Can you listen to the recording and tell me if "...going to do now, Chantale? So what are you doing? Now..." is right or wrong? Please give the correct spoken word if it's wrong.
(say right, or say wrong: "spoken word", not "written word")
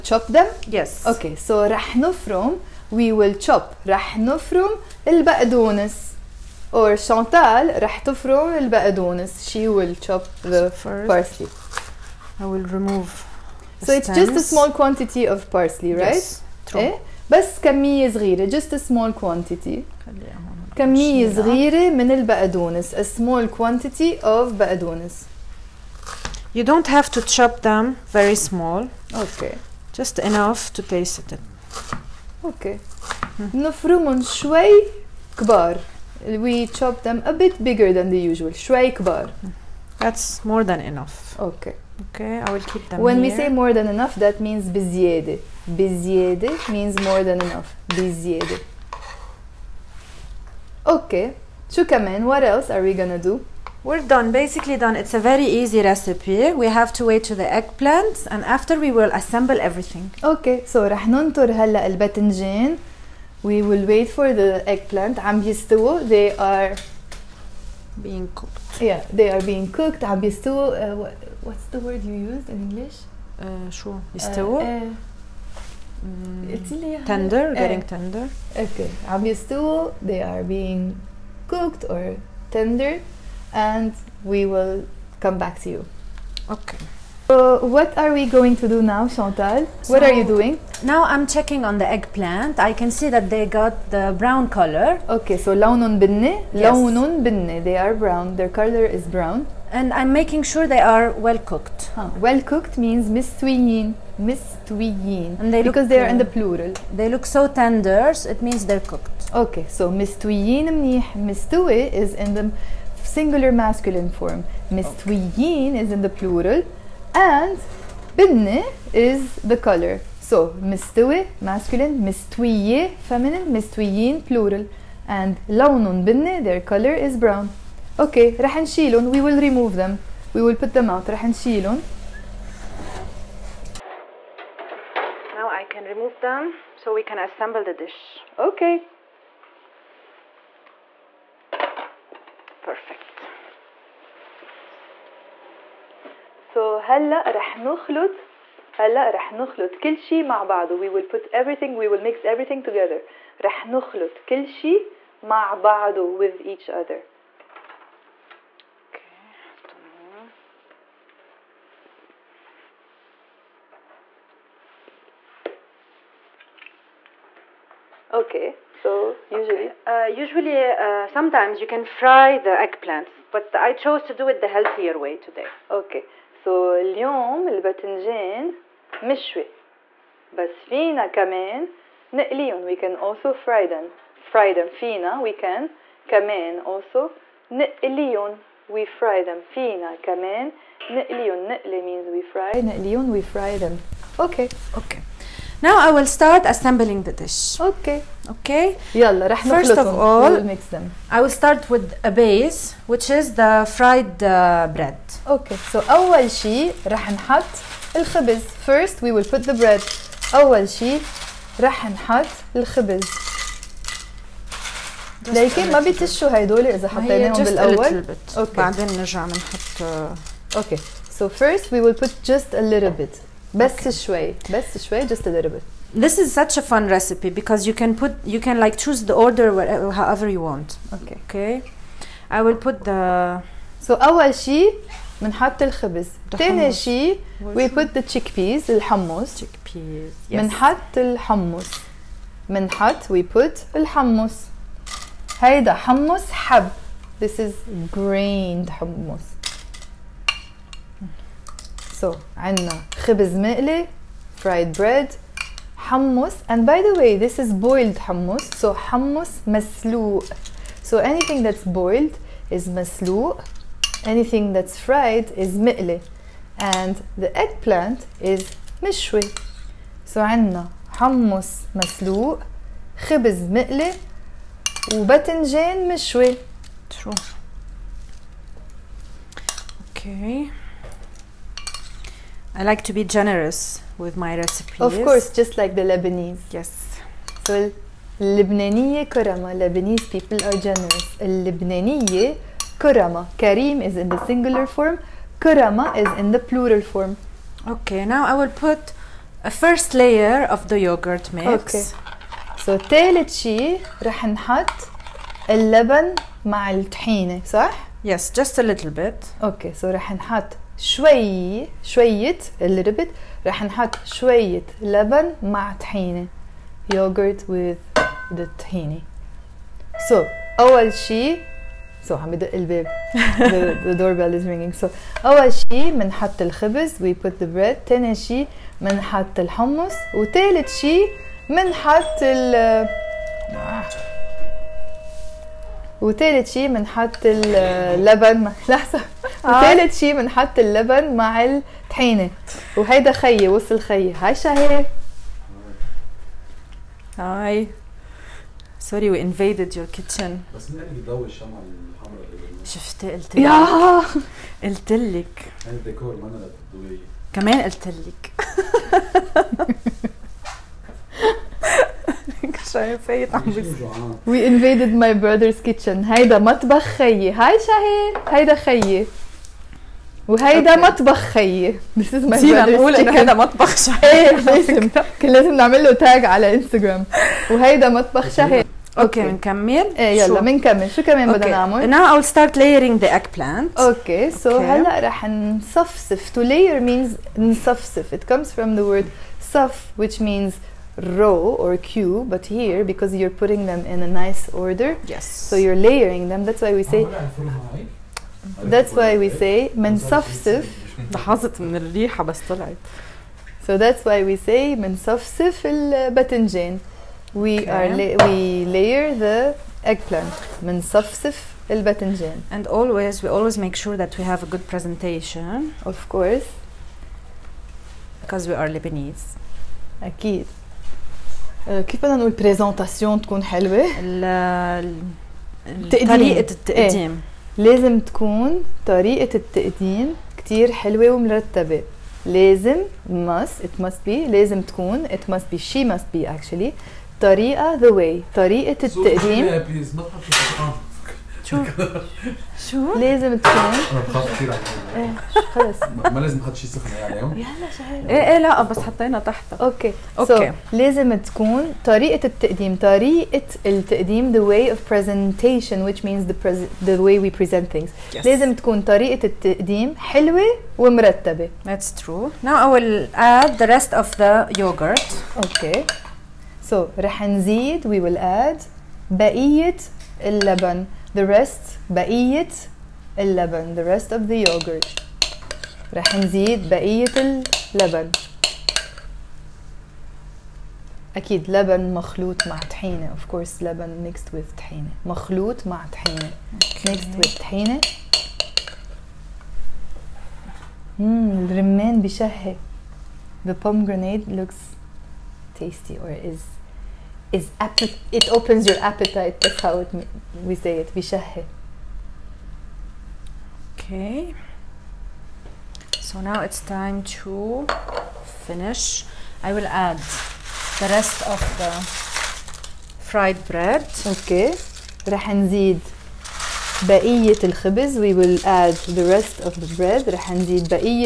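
right.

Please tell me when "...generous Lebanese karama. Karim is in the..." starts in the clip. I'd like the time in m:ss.
4:50.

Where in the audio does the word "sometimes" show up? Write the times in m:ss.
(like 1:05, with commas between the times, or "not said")
2:51.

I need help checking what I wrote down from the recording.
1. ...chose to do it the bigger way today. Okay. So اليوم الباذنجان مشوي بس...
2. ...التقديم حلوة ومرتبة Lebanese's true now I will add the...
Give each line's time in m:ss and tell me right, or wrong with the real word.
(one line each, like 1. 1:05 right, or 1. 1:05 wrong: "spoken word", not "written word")
1. 2:53 wrong: "healthier", not "bigger"
2. 7:39 wrong: "That", not "Lebanese".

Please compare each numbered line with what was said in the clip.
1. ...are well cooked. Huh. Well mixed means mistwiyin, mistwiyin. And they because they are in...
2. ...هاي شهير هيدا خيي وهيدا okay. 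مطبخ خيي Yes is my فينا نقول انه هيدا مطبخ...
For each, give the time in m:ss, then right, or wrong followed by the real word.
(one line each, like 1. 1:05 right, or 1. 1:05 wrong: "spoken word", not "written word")
1. 1:40 wrong: "cooked", not "mixed"
2. 6:07 wrong: "This", not "Yes".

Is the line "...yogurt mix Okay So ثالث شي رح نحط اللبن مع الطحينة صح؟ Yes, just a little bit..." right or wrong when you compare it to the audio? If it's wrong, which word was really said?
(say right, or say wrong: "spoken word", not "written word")
right.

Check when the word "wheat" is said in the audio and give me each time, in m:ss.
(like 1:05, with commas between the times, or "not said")
not said.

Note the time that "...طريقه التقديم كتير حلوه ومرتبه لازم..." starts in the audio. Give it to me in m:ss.
7:08.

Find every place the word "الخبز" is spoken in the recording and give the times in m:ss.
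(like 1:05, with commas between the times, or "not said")
3:27, 3:32, 3:55, 5:26, 8:37.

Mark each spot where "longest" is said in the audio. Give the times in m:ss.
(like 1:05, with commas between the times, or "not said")
not said.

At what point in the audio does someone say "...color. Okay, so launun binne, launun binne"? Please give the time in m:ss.
1:34.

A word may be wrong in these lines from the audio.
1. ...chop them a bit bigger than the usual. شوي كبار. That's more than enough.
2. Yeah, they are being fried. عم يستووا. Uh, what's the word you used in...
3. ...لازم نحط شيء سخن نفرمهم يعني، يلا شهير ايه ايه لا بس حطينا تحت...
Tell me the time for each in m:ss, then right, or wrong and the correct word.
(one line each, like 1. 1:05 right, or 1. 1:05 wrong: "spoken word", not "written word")
1. 0:36 right
2. 1:08 wrong: "cooked", not "fried"
3. 7:26 wrong: "عليهم", not "نفرمهم".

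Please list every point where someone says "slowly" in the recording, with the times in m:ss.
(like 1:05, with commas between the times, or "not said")
not said.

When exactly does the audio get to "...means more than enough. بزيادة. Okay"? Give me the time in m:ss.
0:46.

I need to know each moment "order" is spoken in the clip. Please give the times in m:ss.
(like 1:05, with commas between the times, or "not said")
3:49, 6:34.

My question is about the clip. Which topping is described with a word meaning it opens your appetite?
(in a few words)
pomegranate.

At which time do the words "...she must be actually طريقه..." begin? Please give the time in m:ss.
7:15.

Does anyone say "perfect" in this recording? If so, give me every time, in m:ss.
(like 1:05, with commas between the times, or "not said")
2:22.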